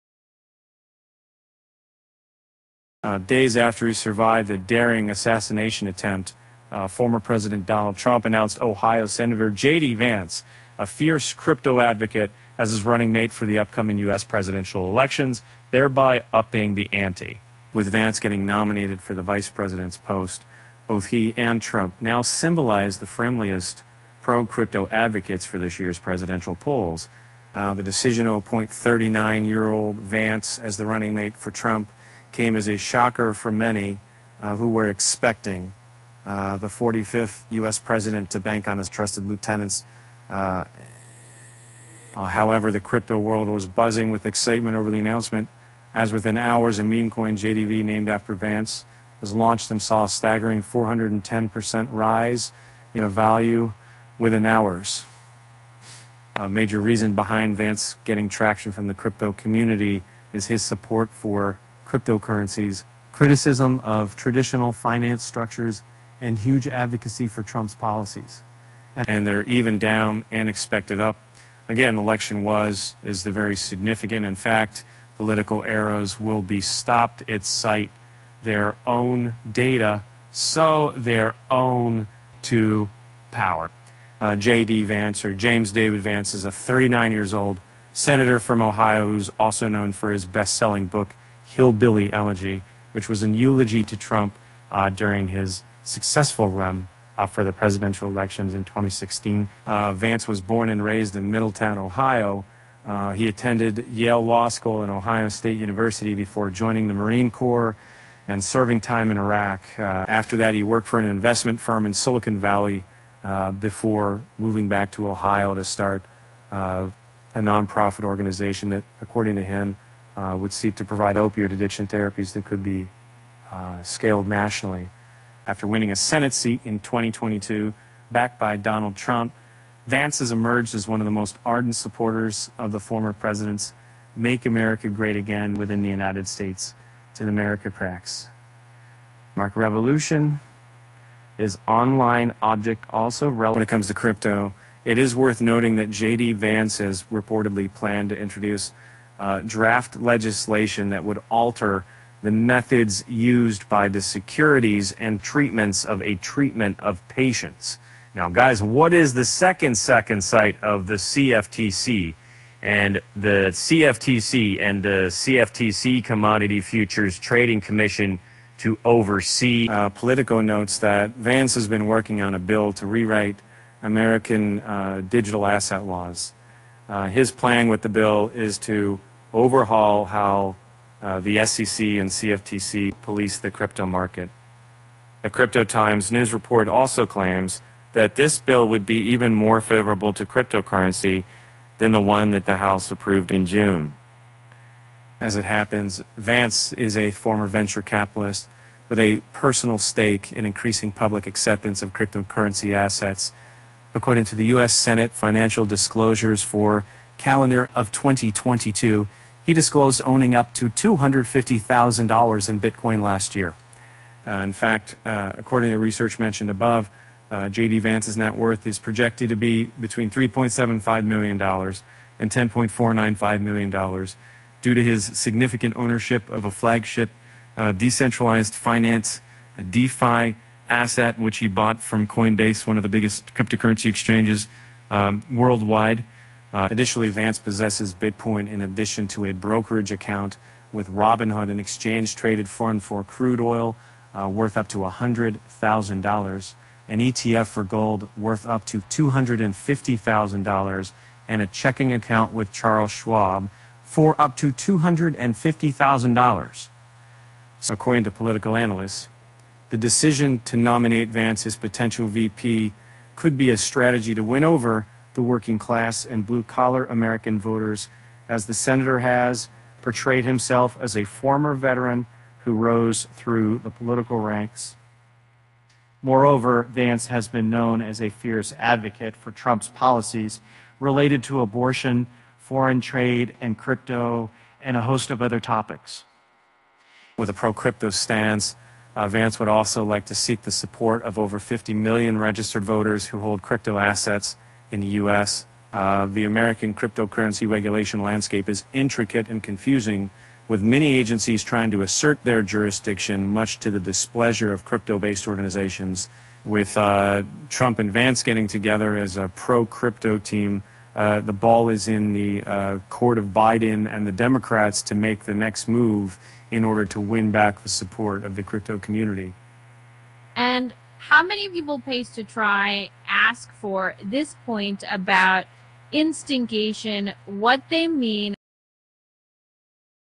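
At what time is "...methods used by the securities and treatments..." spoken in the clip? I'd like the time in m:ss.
2:32.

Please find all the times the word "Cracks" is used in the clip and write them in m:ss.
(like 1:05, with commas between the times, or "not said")
2:17.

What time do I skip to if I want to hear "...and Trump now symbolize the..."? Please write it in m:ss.
0:21.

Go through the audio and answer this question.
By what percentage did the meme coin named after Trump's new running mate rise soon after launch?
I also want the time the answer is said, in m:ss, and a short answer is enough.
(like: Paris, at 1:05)
410%, at 0:50.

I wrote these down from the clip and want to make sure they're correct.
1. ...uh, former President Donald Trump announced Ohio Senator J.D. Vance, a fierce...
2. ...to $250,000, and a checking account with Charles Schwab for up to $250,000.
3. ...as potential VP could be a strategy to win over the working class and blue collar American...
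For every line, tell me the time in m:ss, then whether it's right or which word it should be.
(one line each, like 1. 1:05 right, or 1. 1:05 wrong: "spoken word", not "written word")
1. 0:06 right
2. 4:08 right
3. 4:21 right.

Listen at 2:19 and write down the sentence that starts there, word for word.
Mark Revolution is online object also relevant when it comes to crypto.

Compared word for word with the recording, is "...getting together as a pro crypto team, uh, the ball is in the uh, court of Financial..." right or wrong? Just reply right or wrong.
wrong.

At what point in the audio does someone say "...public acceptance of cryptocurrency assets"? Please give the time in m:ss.
3:20.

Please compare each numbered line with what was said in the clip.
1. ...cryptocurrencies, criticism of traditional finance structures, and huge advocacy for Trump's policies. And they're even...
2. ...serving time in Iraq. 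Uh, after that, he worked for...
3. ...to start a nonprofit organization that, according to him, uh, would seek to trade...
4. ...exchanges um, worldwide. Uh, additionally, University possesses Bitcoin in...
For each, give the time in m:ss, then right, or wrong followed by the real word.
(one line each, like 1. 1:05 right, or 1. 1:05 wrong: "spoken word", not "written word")
1. 1:01 right
2. 1:48 right
3. 1:55 wrong: "provide", not "trade"
4. 3:53 wrong: "Vance", not "University".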